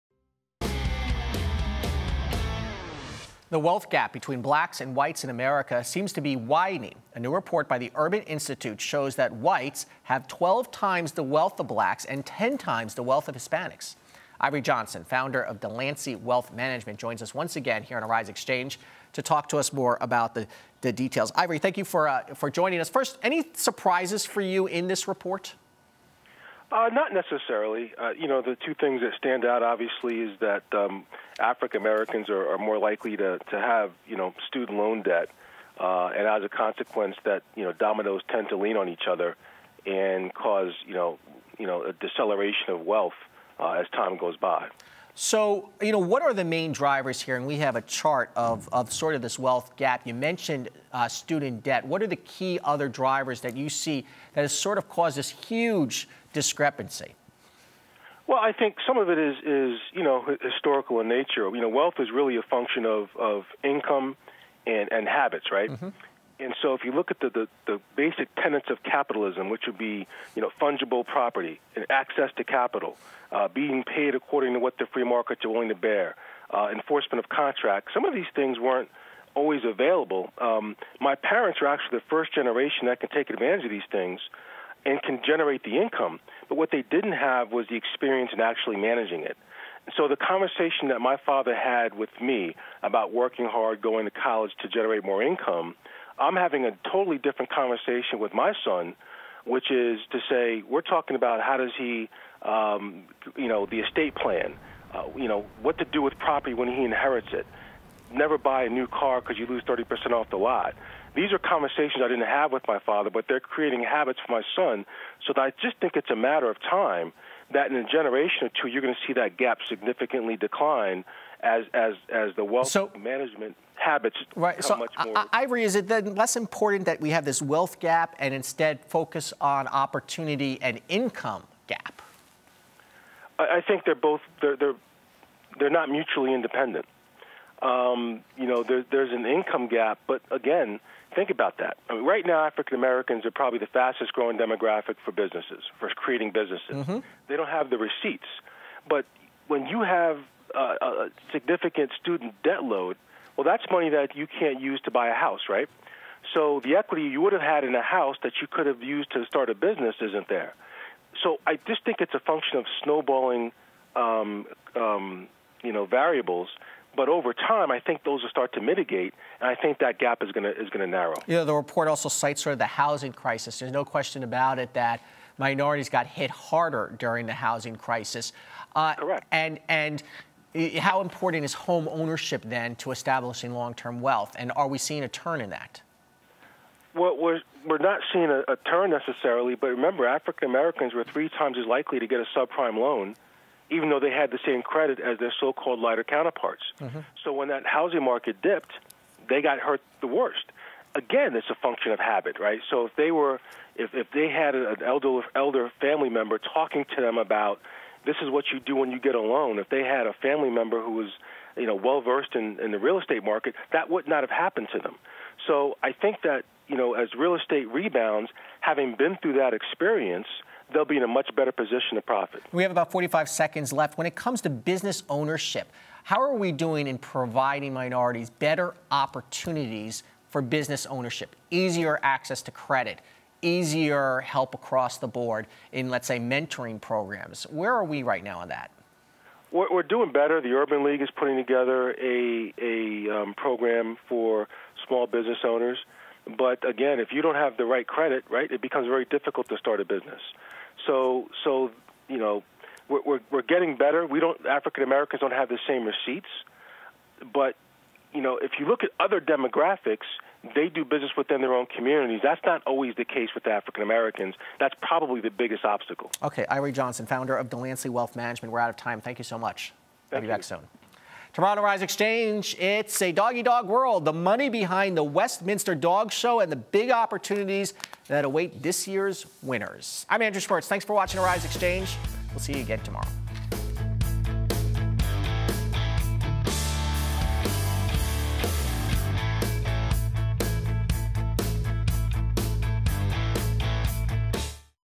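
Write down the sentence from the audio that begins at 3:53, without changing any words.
easier help across the board in, let's say, mentoring programs.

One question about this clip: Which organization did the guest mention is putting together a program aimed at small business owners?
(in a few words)
The Urban League.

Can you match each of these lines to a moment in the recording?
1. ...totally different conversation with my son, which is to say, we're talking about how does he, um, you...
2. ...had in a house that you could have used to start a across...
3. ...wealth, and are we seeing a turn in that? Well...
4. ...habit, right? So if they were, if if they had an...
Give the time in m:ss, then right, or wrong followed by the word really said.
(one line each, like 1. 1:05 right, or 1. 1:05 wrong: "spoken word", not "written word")
1. 1:36 right
2. 2:37 wrong: "business", not "across"
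3. 3:04 right
4. 3:21 right.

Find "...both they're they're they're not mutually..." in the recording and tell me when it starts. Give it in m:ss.
2:13.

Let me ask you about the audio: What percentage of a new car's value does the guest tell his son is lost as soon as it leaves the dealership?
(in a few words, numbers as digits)
30%.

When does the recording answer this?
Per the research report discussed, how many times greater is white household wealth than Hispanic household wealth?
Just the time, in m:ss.
0:12.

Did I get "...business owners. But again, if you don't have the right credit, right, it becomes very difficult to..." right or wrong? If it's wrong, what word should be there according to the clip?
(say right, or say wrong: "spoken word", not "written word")
right.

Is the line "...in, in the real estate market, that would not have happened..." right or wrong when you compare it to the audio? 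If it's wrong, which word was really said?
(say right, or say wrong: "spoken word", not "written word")
right.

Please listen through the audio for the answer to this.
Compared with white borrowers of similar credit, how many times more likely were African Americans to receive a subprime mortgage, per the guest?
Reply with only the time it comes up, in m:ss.
3:11.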